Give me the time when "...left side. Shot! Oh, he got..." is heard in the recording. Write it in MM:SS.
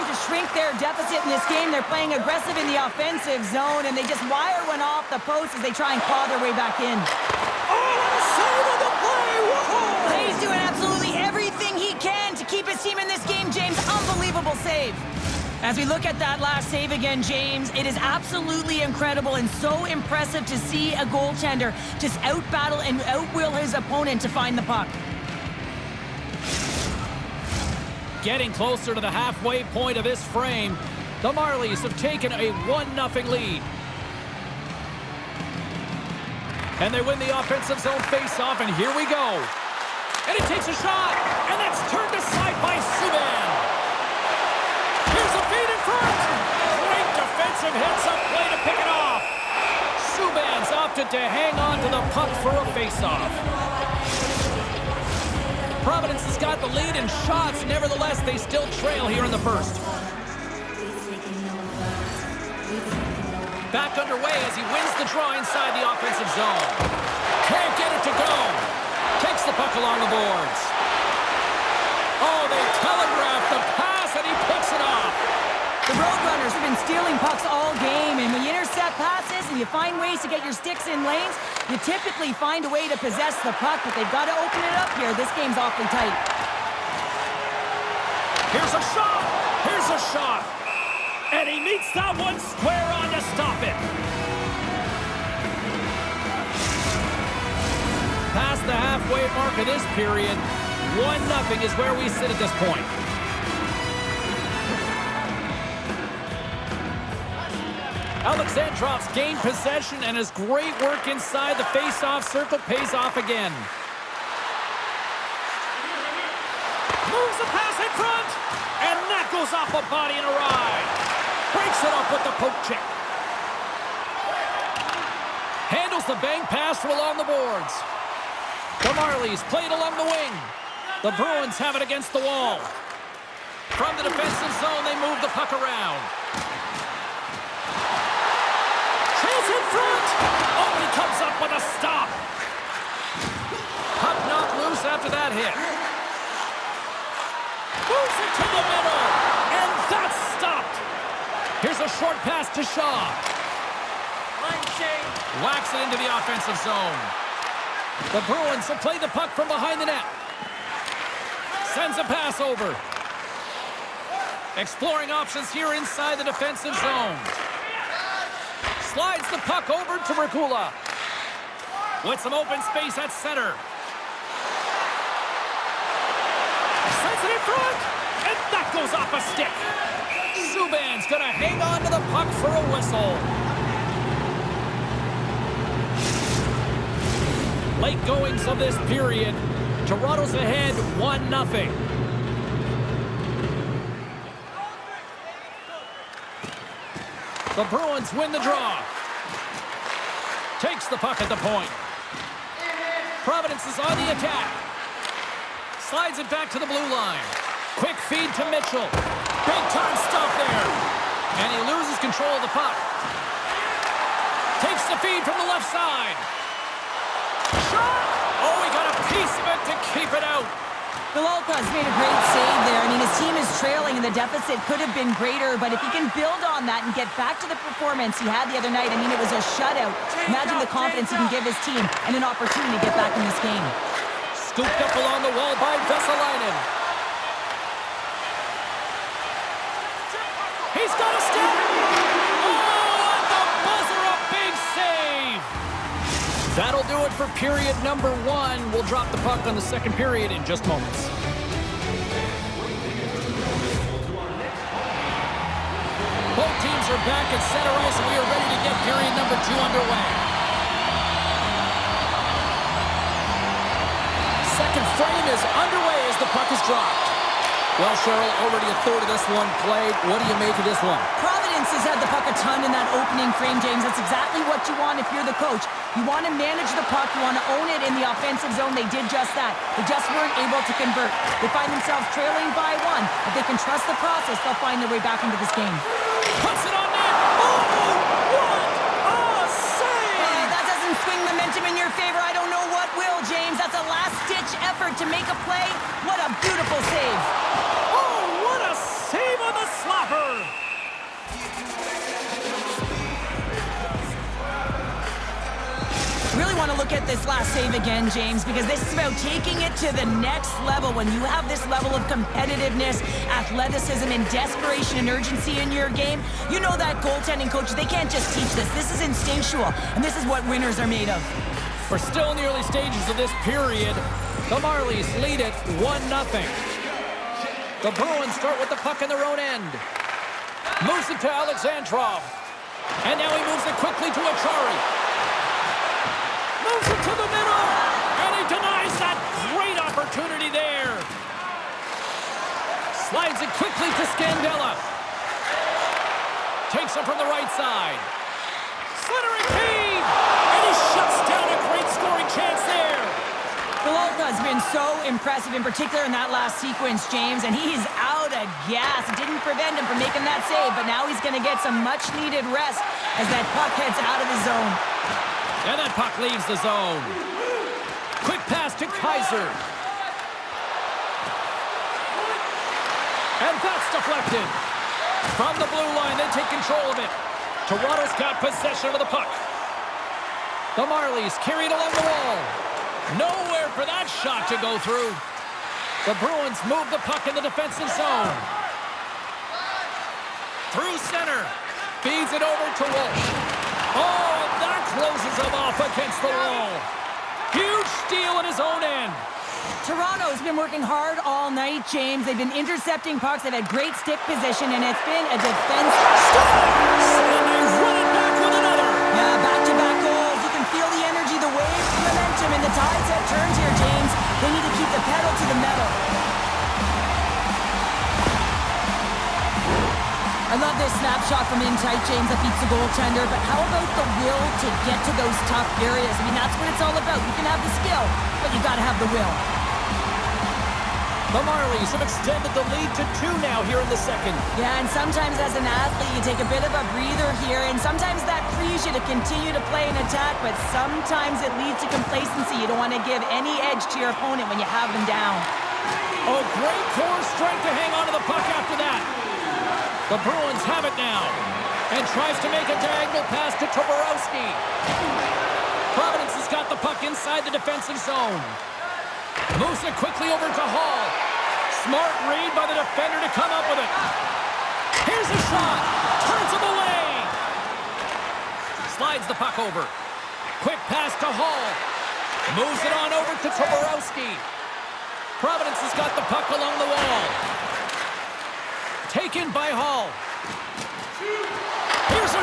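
03:35.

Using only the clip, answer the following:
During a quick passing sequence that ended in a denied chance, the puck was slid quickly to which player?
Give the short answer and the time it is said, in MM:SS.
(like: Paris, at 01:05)
Scandella, at 05:44.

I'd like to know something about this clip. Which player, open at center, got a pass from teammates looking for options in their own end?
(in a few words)
Regula.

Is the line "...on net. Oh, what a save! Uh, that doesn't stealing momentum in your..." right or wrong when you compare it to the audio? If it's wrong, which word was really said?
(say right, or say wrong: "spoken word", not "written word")
wrong: "swing", not "stealing".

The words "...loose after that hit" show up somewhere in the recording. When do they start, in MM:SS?
02:24.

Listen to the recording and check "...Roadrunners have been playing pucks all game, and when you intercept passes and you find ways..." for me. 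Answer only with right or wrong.
wrong.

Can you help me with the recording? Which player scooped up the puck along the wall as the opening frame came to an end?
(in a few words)
Vesalainen.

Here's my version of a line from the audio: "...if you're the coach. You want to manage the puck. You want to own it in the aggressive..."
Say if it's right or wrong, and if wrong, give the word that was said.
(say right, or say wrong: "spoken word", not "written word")
wrong: "offensive", not "aggressive".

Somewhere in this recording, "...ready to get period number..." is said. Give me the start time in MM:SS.
04:18.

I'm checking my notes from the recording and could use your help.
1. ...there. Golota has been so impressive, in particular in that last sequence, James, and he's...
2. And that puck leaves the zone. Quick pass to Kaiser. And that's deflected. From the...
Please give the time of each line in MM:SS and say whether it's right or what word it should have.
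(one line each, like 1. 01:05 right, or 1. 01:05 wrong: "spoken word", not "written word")
1. 05:52 right
2. 06:05 right.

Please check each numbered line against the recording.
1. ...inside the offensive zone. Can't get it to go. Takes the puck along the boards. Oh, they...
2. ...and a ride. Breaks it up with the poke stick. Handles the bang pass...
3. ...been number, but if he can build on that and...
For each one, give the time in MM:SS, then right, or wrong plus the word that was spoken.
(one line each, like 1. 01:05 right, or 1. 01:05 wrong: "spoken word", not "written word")
1. 01:05 right
2. 02:00 wrong: "check", not "stick"
3. 03:44 wrong: "greater", not "number".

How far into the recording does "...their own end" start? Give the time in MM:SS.
05:29.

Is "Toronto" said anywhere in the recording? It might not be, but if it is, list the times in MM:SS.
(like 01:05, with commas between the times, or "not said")
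03:09, 06:17, 06:39.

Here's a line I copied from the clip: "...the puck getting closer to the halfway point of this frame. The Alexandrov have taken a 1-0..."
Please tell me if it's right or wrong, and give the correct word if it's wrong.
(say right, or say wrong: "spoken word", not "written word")
wrong: "Marlies", not "Alexandrov".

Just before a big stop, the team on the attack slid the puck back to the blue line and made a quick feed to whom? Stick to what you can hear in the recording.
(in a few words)
Mitchell.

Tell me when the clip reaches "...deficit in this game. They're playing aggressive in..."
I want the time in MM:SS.
00:00.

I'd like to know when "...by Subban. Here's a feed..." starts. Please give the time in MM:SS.
00:42.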